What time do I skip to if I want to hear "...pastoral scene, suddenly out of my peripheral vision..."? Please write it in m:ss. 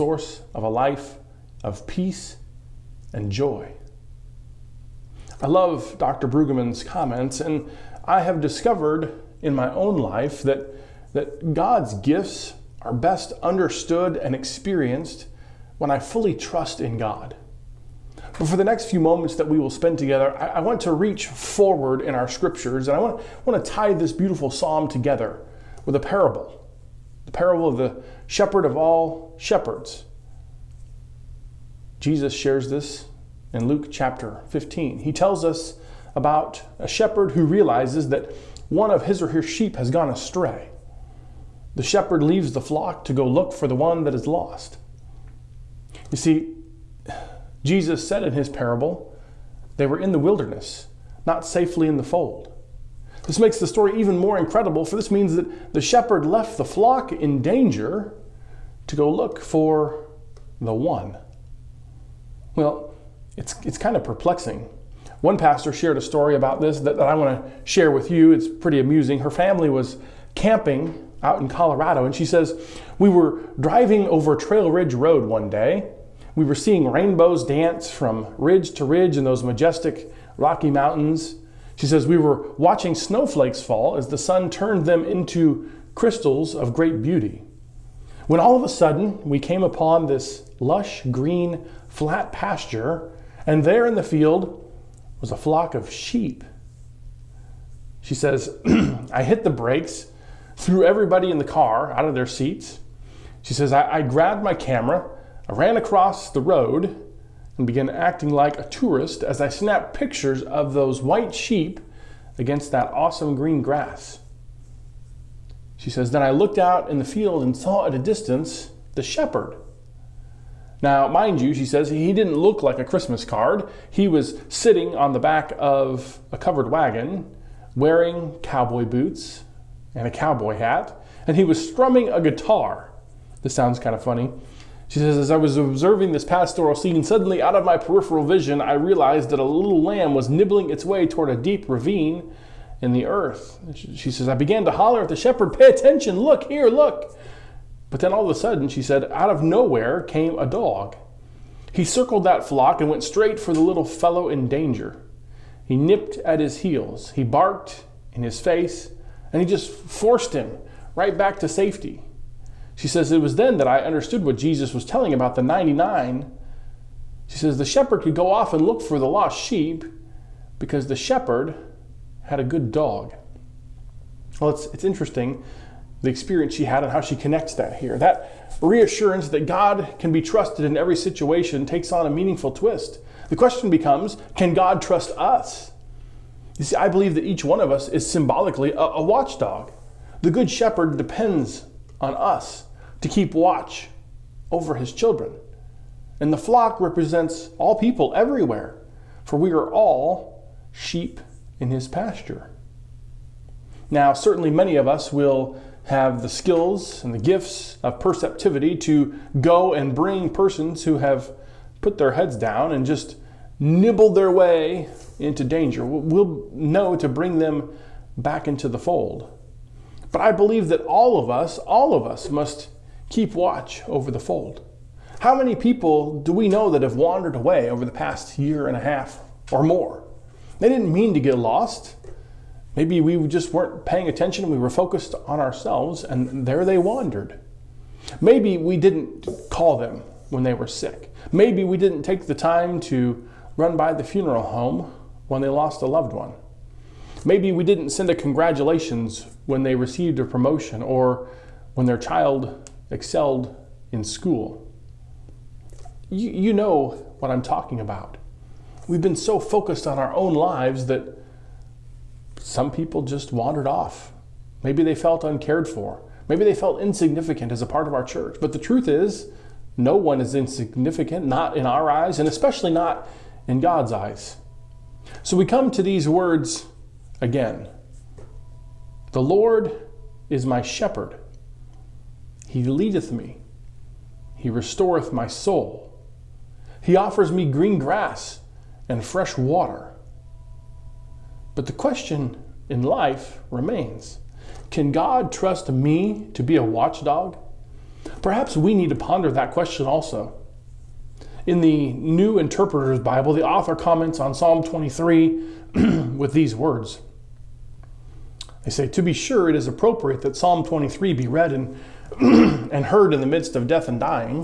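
2:16.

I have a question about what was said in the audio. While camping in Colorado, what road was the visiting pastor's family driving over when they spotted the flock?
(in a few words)
Trail Ridge Road.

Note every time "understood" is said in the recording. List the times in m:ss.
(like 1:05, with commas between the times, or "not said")
0:13, 2:43.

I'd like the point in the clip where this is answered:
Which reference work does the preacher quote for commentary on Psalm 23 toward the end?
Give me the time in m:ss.
5:01.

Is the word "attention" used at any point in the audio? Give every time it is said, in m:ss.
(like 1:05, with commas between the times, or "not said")
2:25, 3:54.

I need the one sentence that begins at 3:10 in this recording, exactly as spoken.
The Good Shepherd depends on us to keep watch over his children.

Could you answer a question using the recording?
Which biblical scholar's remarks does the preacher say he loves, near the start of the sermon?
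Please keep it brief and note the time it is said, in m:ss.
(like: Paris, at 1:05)
Dr. Brueggemann, at 0:05.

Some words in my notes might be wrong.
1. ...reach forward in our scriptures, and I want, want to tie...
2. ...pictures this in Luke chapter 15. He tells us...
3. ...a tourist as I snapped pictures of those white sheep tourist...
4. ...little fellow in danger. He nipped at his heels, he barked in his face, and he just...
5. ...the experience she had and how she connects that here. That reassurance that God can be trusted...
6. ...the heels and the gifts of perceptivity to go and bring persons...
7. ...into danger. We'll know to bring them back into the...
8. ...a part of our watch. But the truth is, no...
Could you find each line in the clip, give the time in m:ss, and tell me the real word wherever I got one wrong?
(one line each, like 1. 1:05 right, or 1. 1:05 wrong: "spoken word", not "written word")
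1. 0:20 right
2. 0:32 wrong: "shares", not "pictures"
3. 1:48 wrong: "against", not "tourist"
4. 2:33 right
5. 2:56 right
6. 3:26 wrong: "skills", not "heels"
7. 3:35 right
8. 4:27 wrong: "church", not "watch".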